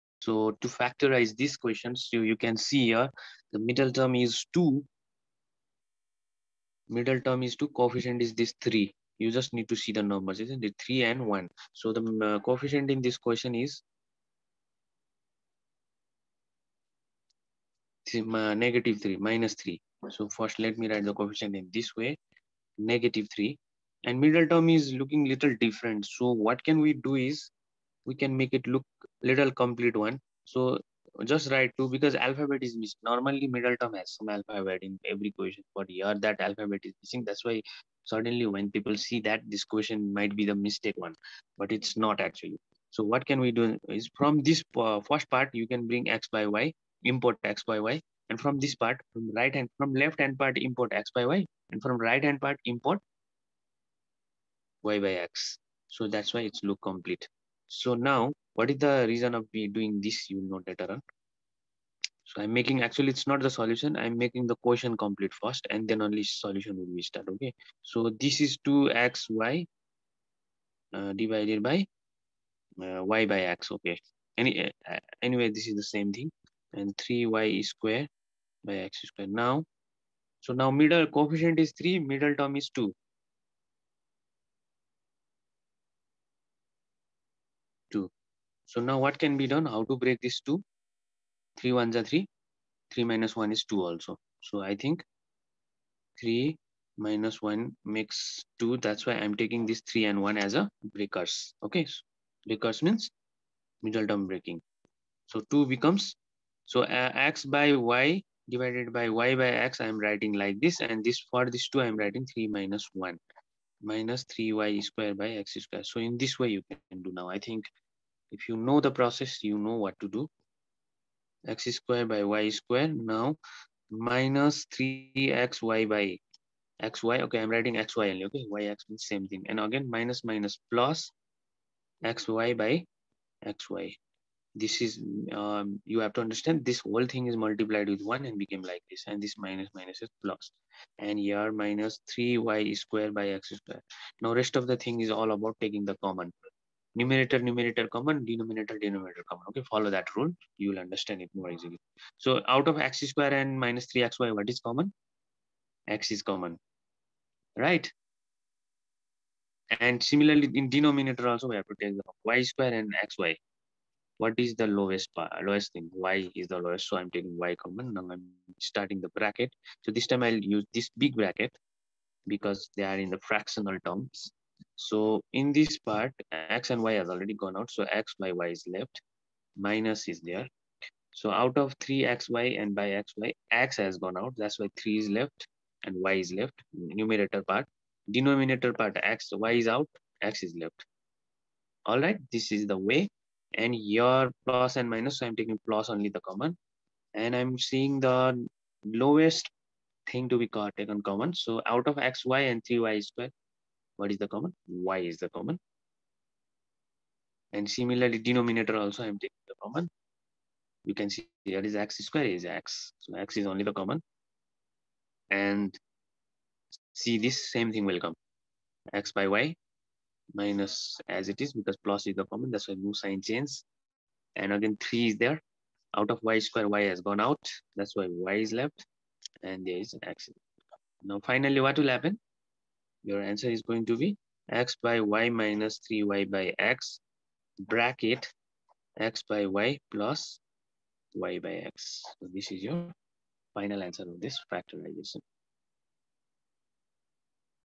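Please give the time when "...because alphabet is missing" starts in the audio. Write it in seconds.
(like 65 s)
31 s.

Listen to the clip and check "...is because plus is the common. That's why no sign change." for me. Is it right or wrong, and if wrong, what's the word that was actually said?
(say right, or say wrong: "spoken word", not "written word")
right.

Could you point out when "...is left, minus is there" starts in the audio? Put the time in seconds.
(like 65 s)
178 s.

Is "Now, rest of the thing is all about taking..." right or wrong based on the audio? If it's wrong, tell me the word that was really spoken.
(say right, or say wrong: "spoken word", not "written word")
right.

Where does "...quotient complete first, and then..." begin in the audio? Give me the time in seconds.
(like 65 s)
64 s.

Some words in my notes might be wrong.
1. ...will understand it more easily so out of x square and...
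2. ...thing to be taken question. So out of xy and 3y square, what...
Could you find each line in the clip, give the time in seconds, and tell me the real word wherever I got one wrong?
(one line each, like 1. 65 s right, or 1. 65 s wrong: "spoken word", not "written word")
1. 150 s right
2. 200 s wrong: "common", not "question".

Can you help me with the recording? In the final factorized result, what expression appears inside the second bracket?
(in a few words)
x by y plus y by x.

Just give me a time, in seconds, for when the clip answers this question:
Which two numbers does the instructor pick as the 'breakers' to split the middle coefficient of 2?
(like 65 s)
99 s.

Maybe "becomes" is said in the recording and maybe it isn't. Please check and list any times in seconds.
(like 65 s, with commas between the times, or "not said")
105 s.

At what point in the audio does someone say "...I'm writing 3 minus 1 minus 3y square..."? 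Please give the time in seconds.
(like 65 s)
111 s.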